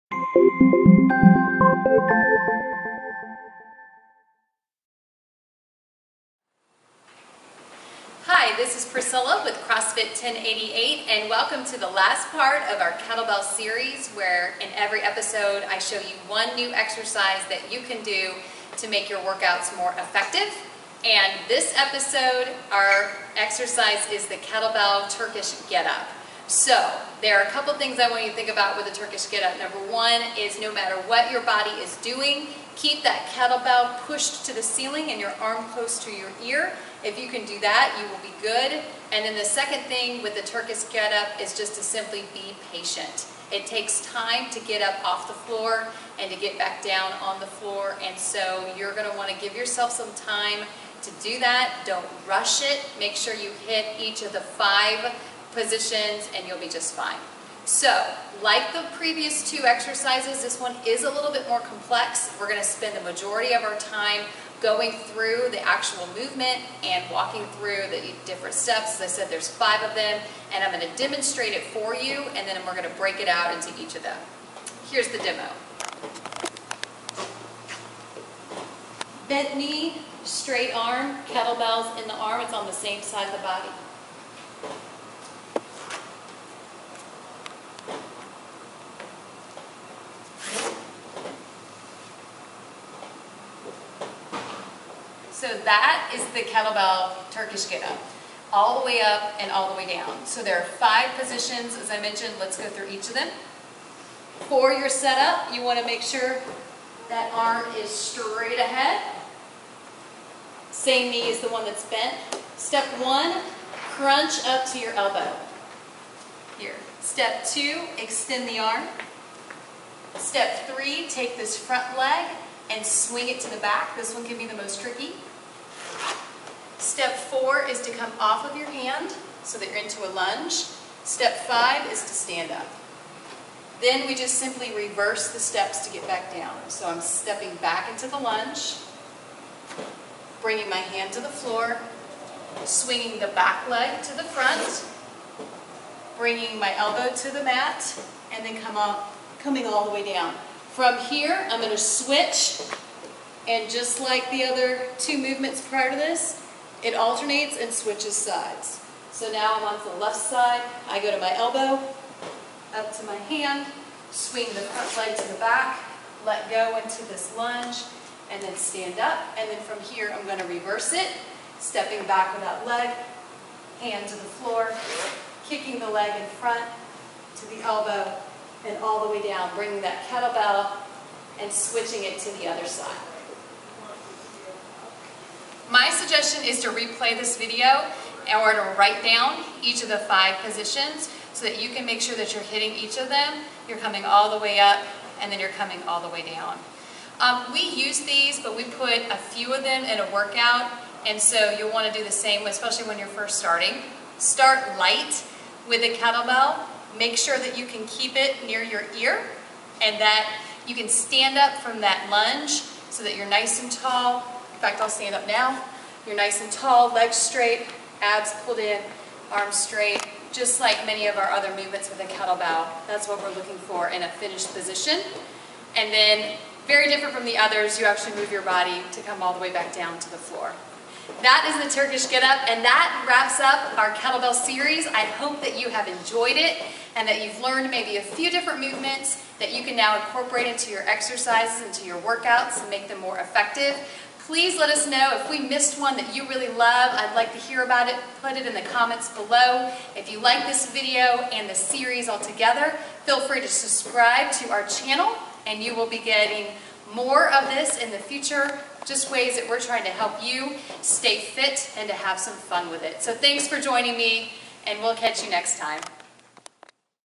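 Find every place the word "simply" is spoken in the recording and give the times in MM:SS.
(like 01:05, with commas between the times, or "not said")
00:41, 02:14.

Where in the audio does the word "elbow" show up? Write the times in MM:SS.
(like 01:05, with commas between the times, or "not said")
01:54, 02:26, 02:41, 02:57.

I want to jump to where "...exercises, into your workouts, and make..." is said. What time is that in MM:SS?
04:00.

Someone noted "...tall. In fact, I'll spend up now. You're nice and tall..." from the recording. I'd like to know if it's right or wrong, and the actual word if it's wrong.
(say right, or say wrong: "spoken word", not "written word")
wrong: "stand", not "spend".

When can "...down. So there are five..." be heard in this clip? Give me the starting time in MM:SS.
01:39.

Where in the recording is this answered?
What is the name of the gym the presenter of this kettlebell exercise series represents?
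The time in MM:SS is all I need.
00:09.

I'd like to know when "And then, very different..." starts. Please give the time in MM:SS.
03:45.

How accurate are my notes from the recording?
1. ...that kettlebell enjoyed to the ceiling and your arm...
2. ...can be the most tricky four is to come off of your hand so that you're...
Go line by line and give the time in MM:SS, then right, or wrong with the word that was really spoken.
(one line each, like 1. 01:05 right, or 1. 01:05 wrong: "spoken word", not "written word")
1. 00:33 wrong: "pushed", not "enjoyed"
2. 02:04 right.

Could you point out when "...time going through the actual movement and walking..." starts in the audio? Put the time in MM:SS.
01:03.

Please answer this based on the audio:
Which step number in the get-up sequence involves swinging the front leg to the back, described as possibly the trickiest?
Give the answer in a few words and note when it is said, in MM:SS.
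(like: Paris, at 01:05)
3, at 02:00.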